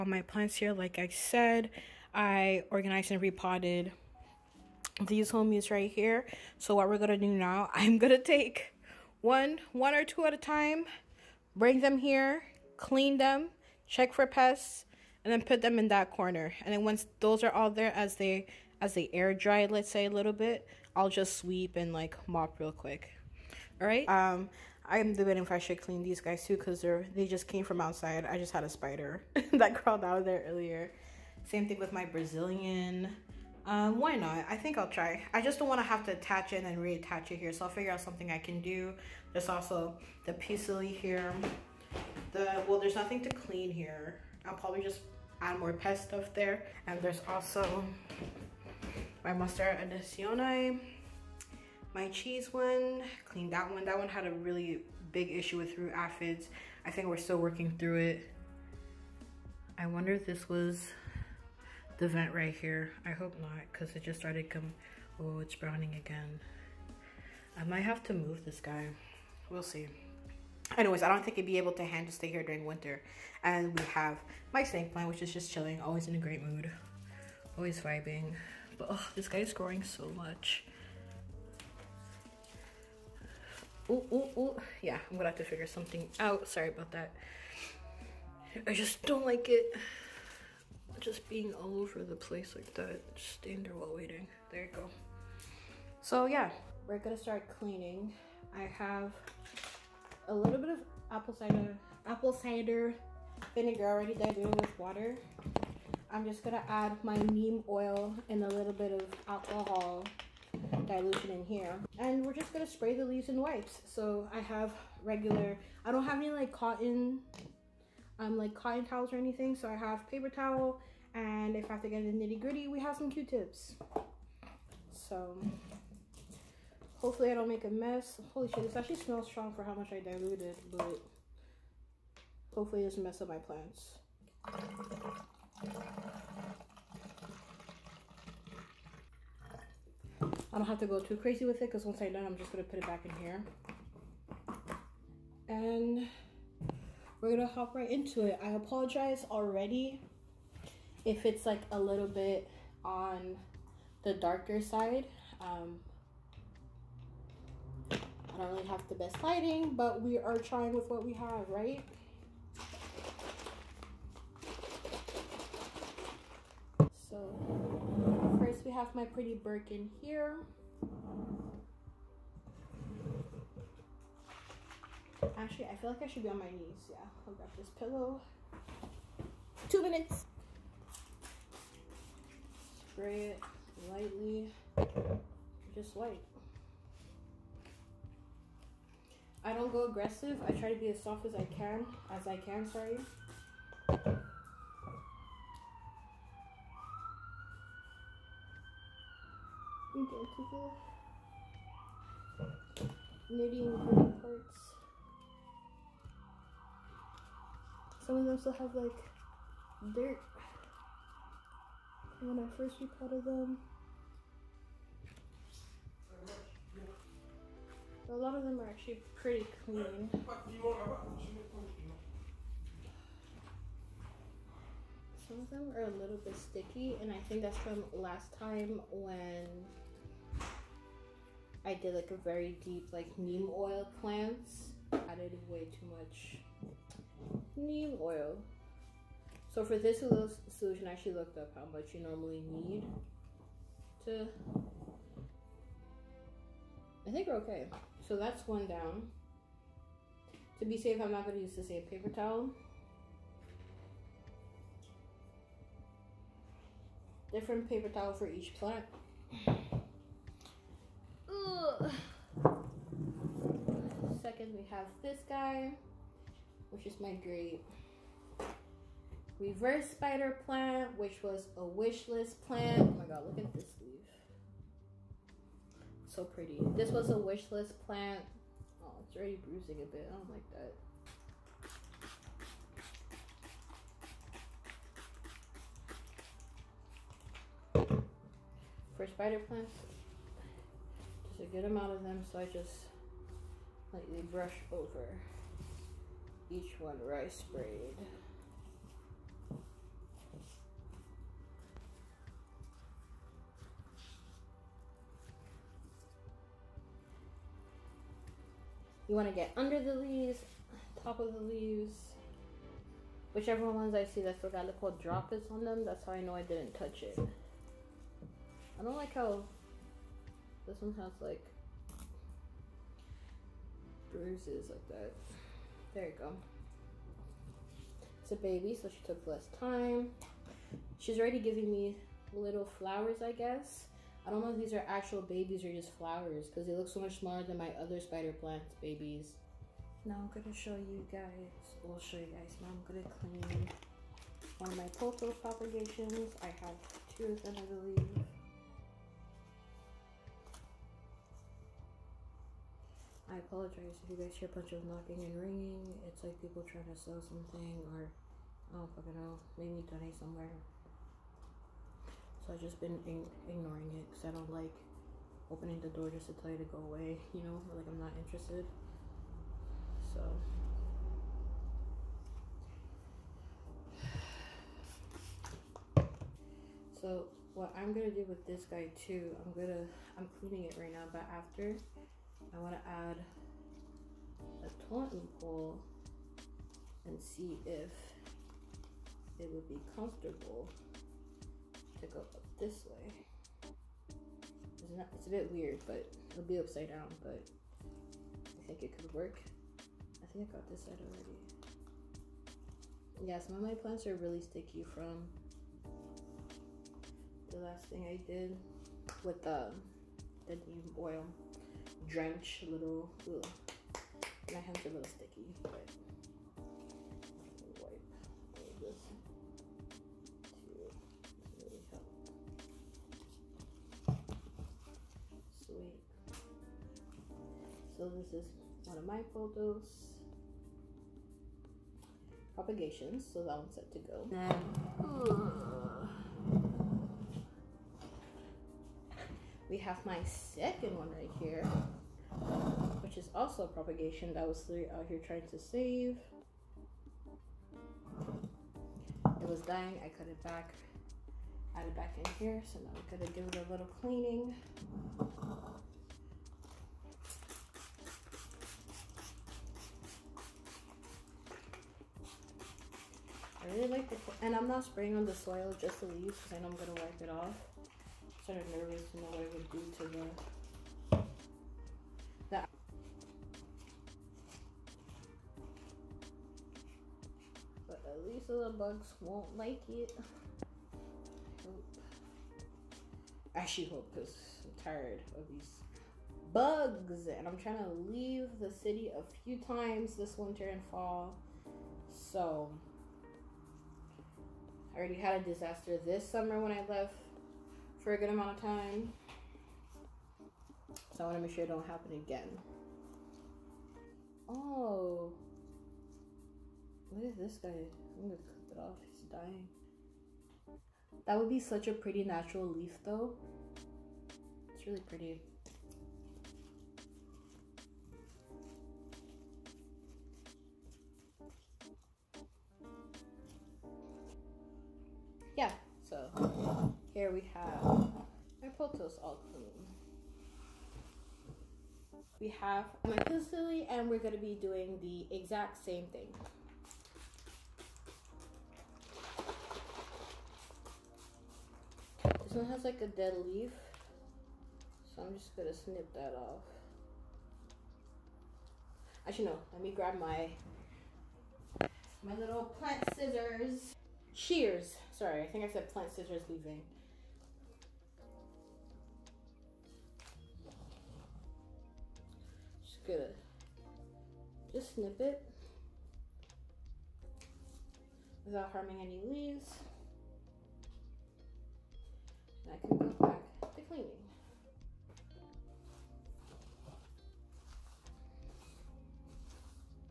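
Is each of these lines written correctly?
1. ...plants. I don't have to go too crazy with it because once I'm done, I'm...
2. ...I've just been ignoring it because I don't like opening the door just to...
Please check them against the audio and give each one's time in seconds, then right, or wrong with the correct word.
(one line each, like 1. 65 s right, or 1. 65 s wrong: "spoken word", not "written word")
1. 133 s right
2. 362 s right.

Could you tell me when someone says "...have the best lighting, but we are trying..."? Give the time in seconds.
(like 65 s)
158 s.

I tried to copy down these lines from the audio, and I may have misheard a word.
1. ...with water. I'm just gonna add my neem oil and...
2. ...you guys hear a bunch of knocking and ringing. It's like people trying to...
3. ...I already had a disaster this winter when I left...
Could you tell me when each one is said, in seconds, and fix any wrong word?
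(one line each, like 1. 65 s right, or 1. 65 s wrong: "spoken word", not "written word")
1. 104 s right
2. 354 s right
3. 494 s wrong: "summer", not "winter".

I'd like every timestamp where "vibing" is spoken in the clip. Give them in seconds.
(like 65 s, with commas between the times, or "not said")
77 s.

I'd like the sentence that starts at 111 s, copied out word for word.
And we're just gonna spray the leaves and wipes.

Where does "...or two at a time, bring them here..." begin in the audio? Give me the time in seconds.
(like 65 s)
9 s.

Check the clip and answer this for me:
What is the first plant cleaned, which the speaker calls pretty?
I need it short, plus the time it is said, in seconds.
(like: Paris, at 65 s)
Birkin, at 169 s.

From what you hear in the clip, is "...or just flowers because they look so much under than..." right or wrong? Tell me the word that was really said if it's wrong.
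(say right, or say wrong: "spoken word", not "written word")
wrong: "smaller", not "under".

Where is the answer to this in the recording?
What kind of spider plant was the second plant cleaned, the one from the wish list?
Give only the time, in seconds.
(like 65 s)
269 s.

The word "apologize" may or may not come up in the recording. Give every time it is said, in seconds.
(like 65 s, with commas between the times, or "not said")
148 s, 353 s.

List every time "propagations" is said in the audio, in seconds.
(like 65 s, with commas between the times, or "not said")
345 s, 432 s, 443 s.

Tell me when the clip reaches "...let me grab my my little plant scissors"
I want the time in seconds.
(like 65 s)
549 s.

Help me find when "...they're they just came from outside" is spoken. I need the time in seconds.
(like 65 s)
26 s.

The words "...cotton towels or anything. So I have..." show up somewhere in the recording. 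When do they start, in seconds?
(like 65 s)
118 s.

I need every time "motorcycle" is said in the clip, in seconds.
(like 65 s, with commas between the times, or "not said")
not said.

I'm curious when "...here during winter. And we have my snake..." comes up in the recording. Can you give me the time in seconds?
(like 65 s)
72 s.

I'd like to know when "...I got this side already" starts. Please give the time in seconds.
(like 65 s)
400 s.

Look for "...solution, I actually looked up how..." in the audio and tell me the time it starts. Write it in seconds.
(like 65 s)
239 s.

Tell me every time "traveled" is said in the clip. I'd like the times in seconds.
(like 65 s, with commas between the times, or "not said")
not said.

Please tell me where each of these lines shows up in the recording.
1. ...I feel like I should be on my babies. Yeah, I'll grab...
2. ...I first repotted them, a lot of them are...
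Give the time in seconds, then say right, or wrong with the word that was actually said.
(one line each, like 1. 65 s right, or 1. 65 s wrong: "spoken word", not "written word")
1. 175 s wrong: "knees", not "babies"
2. 212 s right.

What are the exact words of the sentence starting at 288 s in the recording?
For spider plants, get them out of them, so I just lightly brush over each one rice braid.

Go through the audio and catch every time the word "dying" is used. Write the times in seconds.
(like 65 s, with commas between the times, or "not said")
449 s, 509 s.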